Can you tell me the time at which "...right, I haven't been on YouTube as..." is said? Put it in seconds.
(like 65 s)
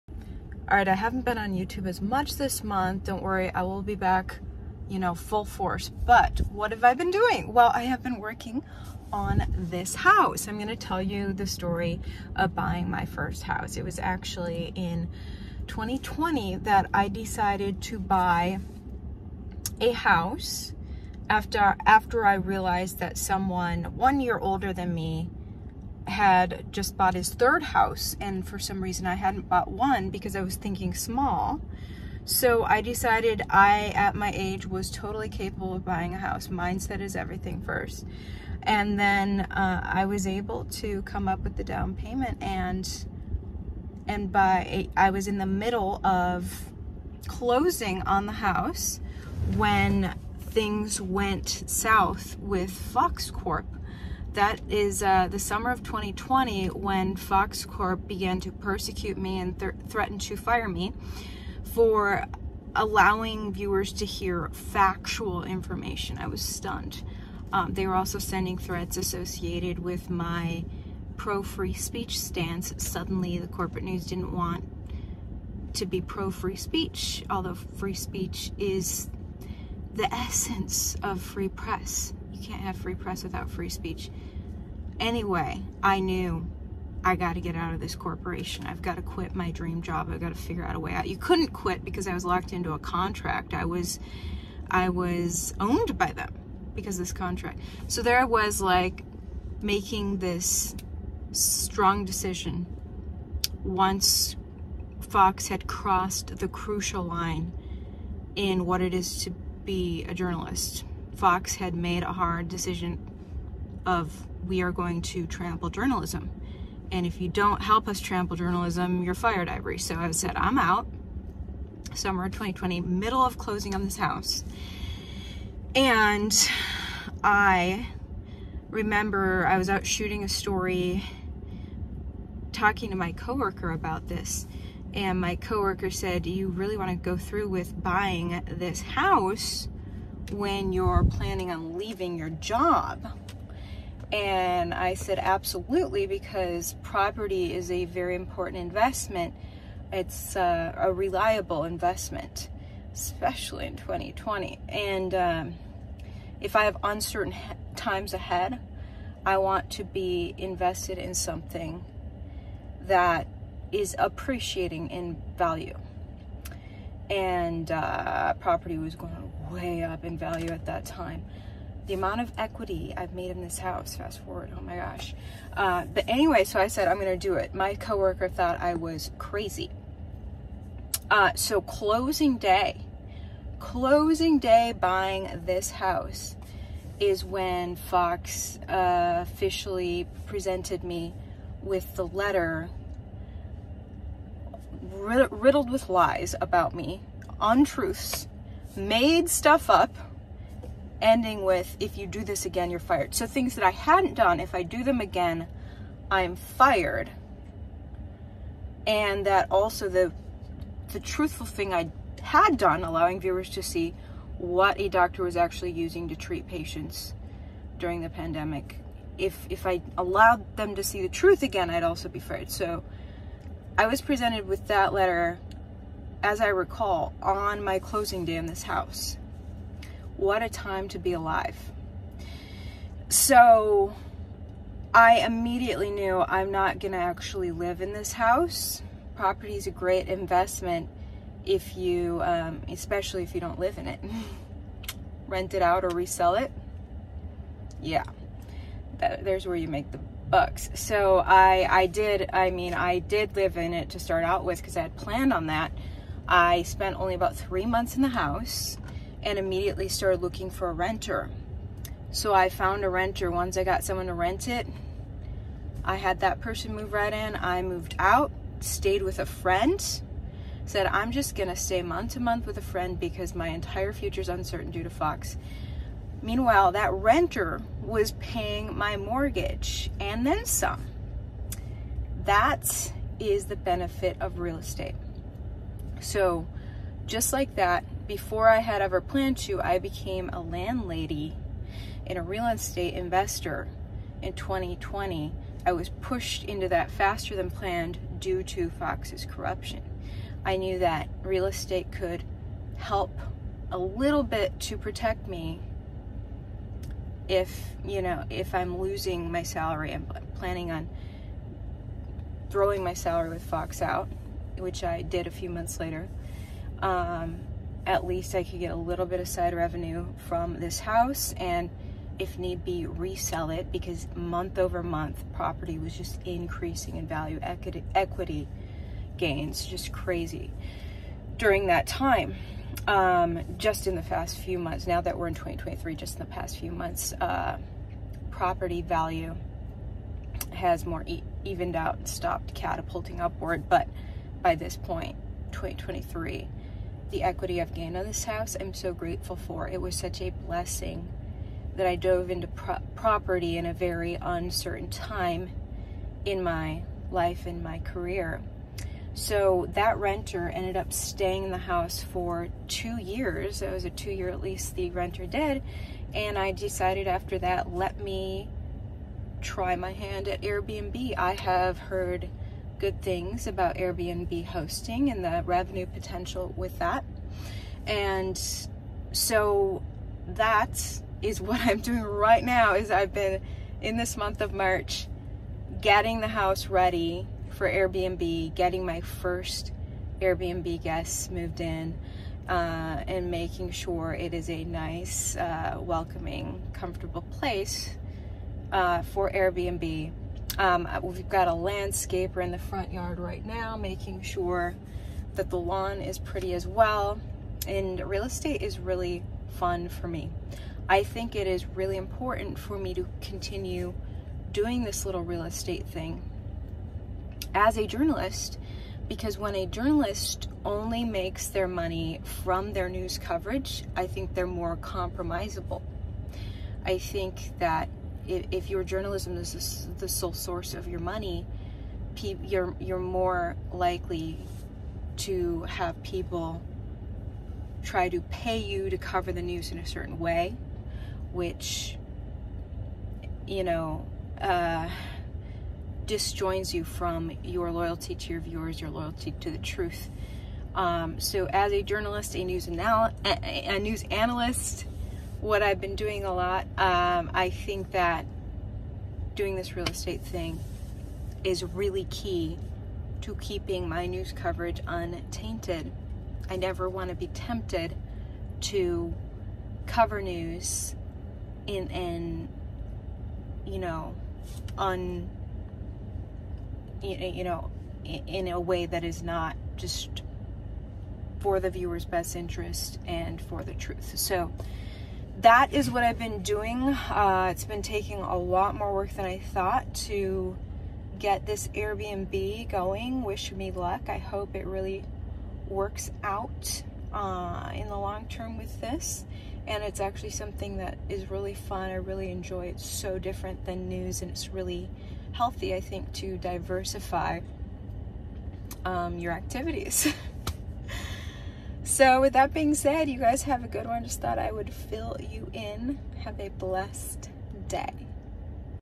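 0 s.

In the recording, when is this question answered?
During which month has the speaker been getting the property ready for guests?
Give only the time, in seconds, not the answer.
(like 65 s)
384 s.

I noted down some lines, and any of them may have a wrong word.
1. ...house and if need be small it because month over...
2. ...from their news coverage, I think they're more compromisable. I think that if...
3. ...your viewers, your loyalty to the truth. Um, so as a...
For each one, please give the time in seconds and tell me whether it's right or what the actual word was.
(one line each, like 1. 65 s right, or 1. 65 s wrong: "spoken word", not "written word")
1. 320 s wrong: "resell", not "small"
2. 422 s right
3. 448 s right.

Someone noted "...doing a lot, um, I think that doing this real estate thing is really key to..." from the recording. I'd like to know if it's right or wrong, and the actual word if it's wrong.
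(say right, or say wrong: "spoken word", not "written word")
right.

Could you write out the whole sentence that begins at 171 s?
The amount of equity I've made in this house, fast forward, oh my gosh.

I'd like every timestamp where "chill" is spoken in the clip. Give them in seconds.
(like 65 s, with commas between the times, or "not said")
not said.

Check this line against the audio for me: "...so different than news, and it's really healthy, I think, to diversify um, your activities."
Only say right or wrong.
right.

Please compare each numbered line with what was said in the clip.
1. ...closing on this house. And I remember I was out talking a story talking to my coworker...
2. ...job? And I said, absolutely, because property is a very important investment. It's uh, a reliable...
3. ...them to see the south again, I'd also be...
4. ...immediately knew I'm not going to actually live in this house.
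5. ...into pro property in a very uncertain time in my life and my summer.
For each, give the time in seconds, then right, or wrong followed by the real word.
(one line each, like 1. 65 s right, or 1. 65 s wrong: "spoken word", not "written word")
1. 123 s wrong: "shooting", not "talking"
2. 142 s right
3. 220 s wrong: "truth", not "south"
4. 235 s right
5. 352 s wrong: "career", not "summer".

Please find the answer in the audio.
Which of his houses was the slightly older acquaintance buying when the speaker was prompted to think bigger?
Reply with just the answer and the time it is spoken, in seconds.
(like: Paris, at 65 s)
third, at 27 s.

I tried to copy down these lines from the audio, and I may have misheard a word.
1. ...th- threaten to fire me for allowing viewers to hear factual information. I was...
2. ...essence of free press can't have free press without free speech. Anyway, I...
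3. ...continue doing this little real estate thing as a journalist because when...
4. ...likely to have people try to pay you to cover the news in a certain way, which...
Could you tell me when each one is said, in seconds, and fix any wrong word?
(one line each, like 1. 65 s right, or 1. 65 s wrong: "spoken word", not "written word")
1. 59 s right
2. 80 s right
3. 413 s right
4. 433 s right.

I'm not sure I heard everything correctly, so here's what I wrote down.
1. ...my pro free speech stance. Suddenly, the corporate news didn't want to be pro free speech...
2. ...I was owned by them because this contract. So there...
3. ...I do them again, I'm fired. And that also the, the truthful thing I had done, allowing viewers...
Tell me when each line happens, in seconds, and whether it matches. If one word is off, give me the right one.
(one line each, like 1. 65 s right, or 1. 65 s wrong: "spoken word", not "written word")
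1. 70 s right
2. 94 s right
3. 204 s right.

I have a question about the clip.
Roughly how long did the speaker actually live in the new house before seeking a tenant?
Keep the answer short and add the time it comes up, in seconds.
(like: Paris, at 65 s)
3 months, at 257 s.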